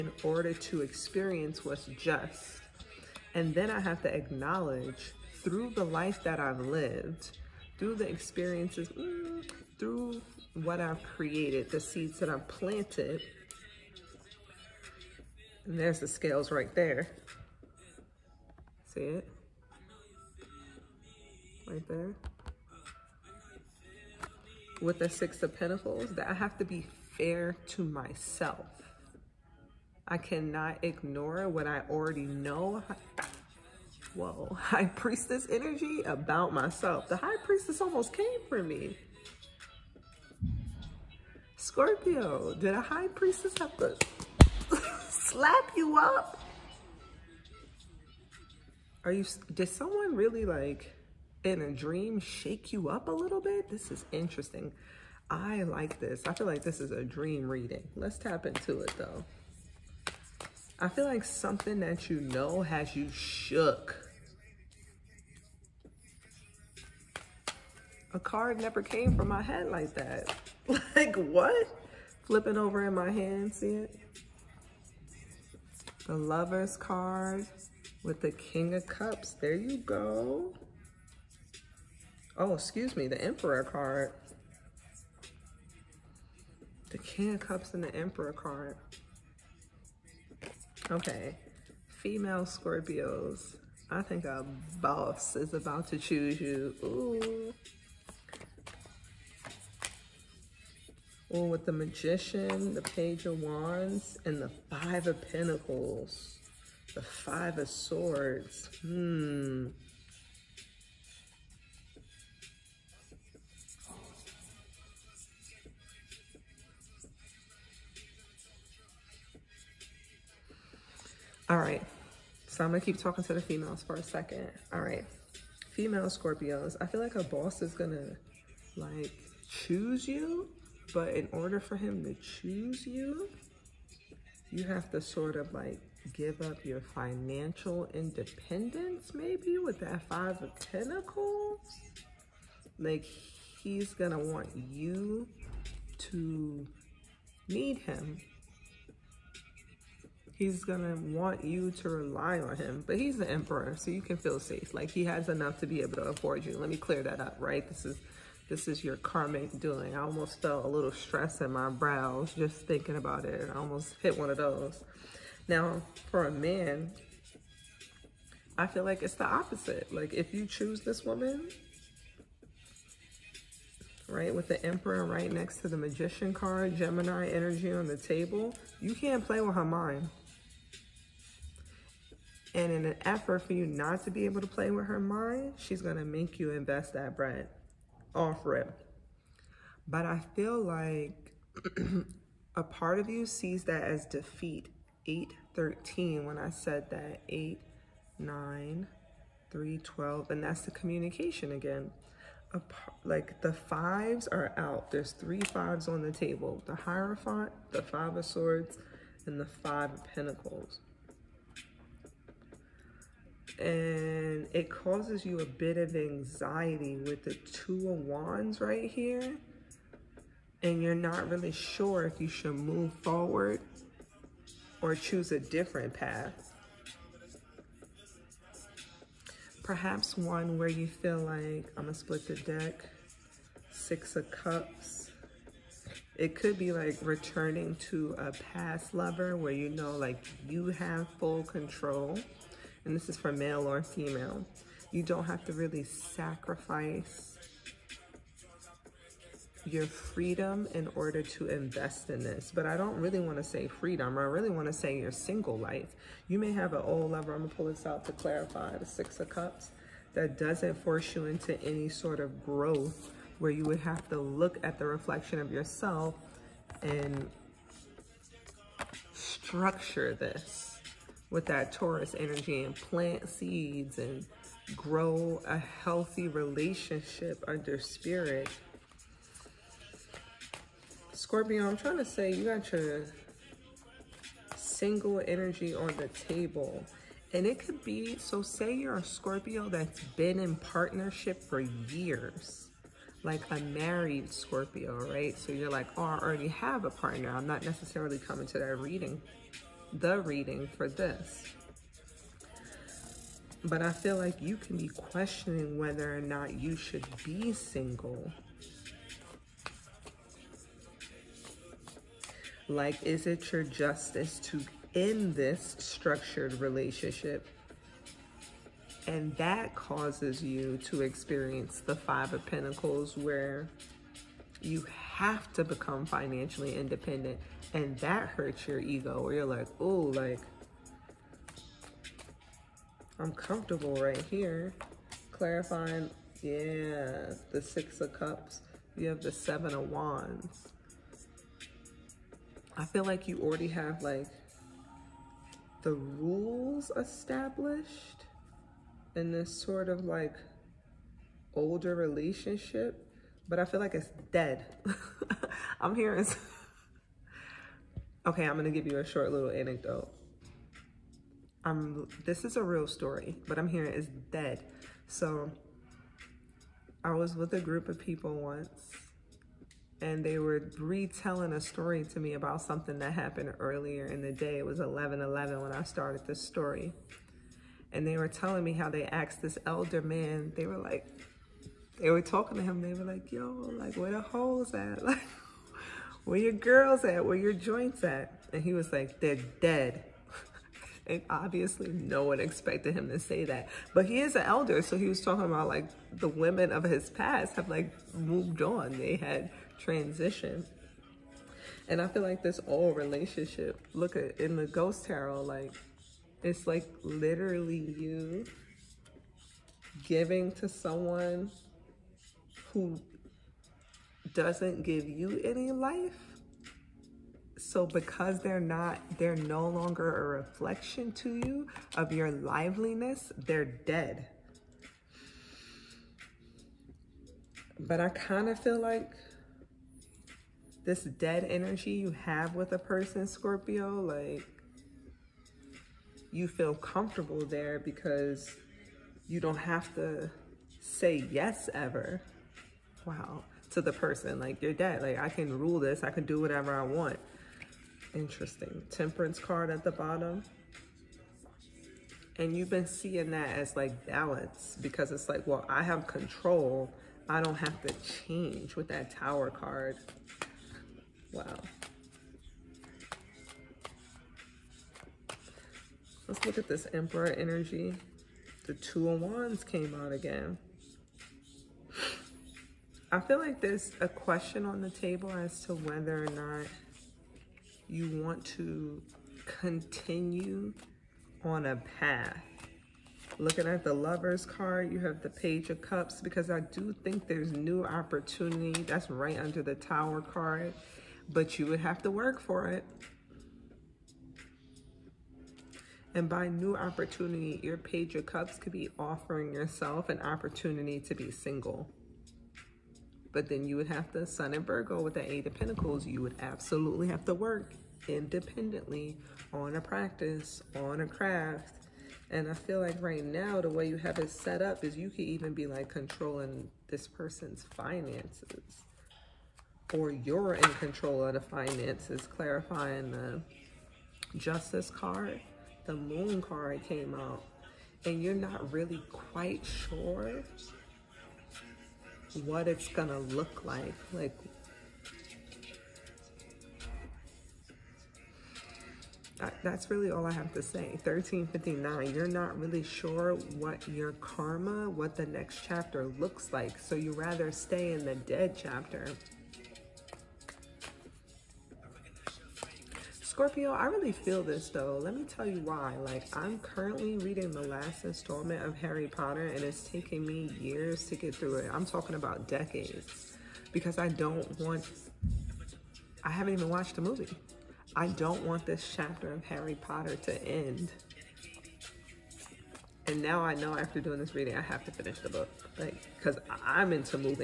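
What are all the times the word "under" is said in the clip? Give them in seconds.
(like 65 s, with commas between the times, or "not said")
277 s, 489 s.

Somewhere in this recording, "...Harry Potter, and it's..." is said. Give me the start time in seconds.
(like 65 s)
558 s.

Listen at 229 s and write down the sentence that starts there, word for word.
Perhaps one where you feel like, I'm gonna split the deck, six of cups.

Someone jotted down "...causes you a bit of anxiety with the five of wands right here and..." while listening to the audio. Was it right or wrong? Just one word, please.
wrong.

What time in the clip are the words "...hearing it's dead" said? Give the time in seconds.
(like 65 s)
363 s.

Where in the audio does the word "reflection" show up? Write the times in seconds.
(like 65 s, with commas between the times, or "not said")
264 s, 420 s.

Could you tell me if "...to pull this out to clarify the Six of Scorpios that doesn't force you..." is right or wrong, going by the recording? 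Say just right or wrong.
wrong.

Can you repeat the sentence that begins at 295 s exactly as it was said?
So you're like, oh, I already have a partner.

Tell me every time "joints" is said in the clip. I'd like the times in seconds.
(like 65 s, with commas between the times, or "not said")
387 s.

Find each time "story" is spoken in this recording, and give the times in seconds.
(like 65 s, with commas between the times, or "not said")
362 s, 371 s, 376 s.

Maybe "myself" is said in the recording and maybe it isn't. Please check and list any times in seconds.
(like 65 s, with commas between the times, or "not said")
27 s, 36 s.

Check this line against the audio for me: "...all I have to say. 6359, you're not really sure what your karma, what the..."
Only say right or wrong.
wrong.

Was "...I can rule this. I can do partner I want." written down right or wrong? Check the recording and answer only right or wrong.
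wrong.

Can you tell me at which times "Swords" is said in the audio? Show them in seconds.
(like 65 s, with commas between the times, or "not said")
107 s, 208 s.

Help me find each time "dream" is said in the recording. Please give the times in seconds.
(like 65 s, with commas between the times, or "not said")
51 s, 57 s.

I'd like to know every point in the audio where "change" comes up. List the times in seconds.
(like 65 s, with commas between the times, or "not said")
458 s.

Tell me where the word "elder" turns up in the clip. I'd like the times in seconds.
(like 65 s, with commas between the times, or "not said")
379 s, 394 s.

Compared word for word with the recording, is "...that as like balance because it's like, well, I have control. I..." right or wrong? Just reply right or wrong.
right.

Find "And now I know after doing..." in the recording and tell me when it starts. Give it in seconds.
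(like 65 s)
573 s.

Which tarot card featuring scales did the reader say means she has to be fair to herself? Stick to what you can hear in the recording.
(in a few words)
Six of Pentacles.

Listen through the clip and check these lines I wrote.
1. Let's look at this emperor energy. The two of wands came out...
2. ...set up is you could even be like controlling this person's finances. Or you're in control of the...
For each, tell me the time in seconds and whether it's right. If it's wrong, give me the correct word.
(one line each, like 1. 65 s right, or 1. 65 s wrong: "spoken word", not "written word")
1. 466 s right
2. 514 s right.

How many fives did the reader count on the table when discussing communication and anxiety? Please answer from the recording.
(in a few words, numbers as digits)
3.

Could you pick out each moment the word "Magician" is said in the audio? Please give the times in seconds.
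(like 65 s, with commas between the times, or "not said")
101 s, 175 s.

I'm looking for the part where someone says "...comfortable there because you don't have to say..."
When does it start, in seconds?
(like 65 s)
436 s.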